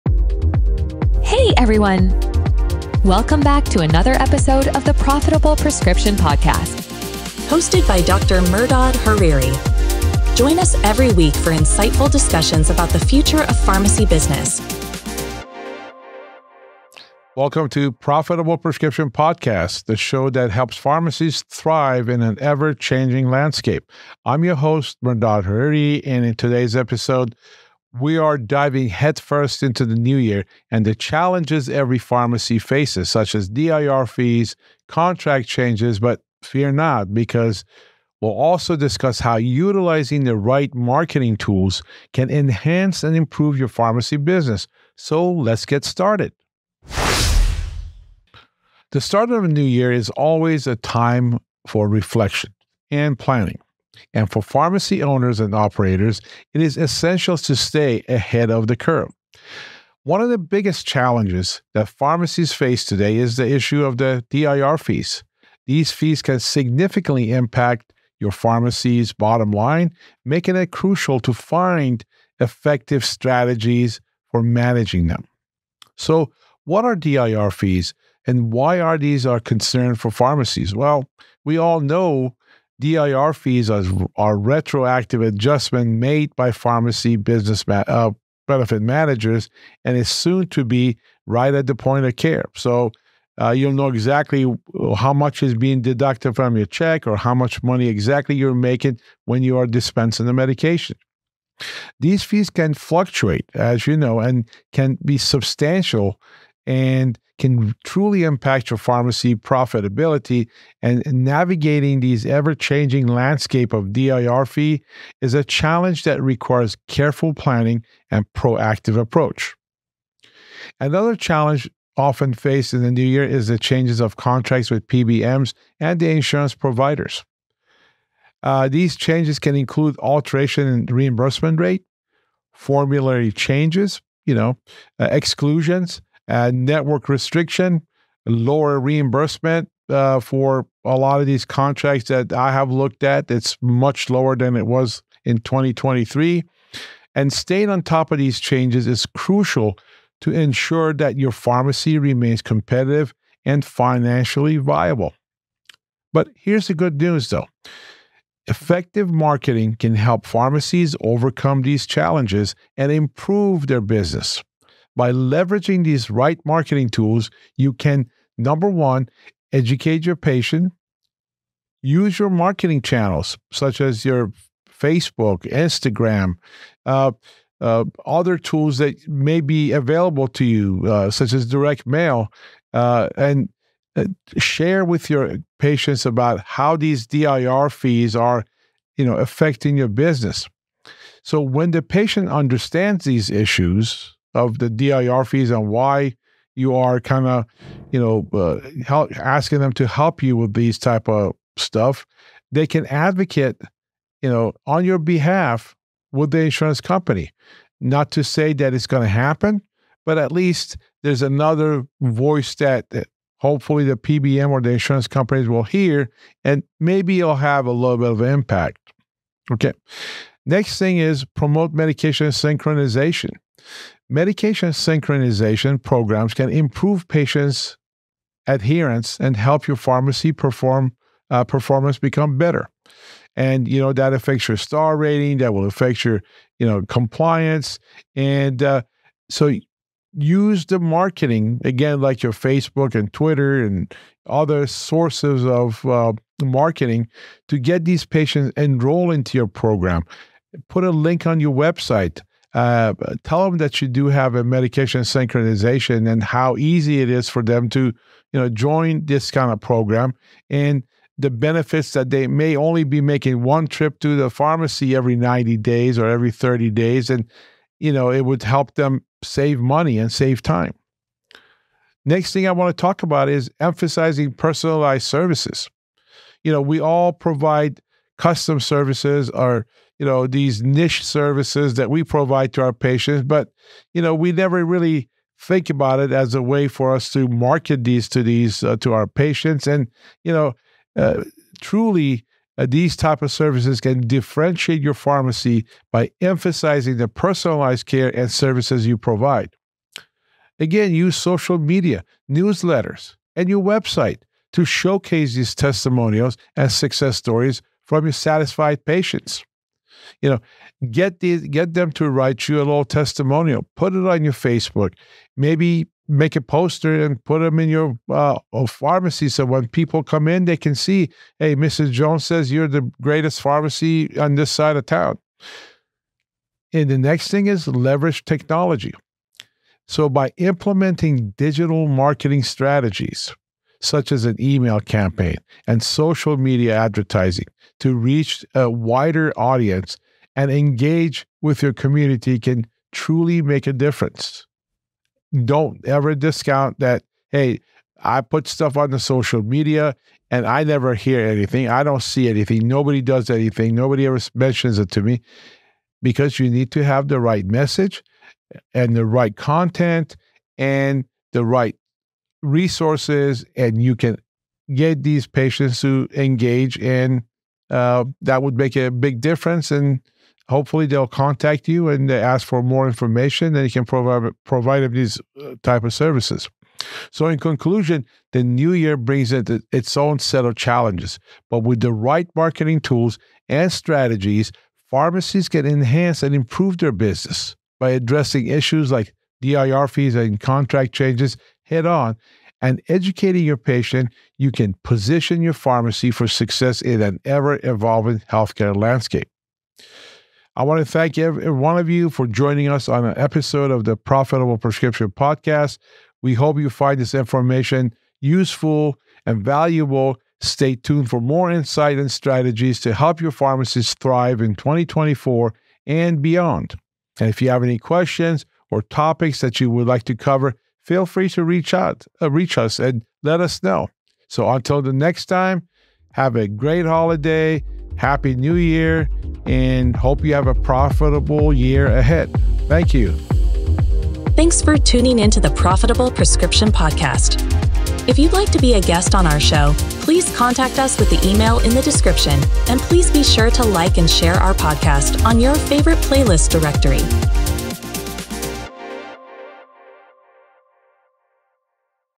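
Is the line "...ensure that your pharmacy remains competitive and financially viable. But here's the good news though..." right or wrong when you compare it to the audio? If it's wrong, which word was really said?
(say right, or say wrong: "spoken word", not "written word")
right.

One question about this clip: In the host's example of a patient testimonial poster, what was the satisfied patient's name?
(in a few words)
Mrs. Jones.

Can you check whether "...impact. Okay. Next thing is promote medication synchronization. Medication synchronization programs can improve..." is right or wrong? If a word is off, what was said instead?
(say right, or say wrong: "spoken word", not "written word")
right.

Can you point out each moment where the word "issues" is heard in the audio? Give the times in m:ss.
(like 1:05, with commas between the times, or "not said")
1:03, 3:13, 6:28.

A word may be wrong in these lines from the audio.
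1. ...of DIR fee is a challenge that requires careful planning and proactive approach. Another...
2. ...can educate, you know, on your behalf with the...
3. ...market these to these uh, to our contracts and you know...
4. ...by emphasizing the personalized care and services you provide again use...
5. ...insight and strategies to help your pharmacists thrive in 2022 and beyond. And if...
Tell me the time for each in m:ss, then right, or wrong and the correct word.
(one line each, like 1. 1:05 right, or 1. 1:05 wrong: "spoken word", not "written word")
1. 1:53 right
2. 3:22 wrong: "advocate", not "educate"
3. 4:47 wrong: "patients", not "contracts"
4. 4:55 right
5. 6:51 wrong: "2024", not "2022".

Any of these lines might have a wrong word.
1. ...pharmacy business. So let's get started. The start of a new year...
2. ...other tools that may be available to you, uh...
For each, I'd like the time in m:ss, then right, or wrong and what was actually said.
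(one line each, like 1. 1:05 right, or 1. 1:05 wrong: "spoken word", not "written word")
1. 0:43 right
2. 2:58 right.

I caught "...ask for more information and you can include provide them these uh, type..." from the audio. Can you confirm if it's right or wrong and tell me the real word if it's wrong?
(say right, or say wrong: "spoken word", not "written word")
wrong: "provide", not "include".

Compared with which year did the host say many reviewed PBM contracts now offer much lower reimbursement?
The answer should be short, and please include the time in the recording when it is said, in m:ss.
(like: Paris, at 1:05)
2023, at 2:25.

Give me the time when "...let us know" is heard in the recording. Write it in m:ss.
7:03.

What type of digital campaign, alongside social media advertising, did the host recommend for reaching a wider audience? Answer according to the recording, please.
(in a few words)
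Email campaign.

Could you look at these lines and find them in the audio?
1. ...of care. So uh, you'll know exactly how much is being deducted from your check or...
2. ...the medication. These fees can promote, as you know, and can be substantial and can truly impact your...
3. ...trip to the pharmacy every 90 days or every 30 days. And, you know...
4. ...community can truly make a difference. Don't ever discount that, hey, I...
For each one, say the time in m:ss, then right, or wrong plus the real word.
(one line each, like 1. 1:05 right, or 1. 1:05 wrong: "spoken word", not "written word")
1. 1:32 right
2. 1:40 wrong: "fluctuate", not "promote"
3. 4:23 right
4. 5:41 right.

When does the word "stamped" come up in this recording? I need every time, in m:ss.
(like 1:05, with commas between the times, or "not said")
not said.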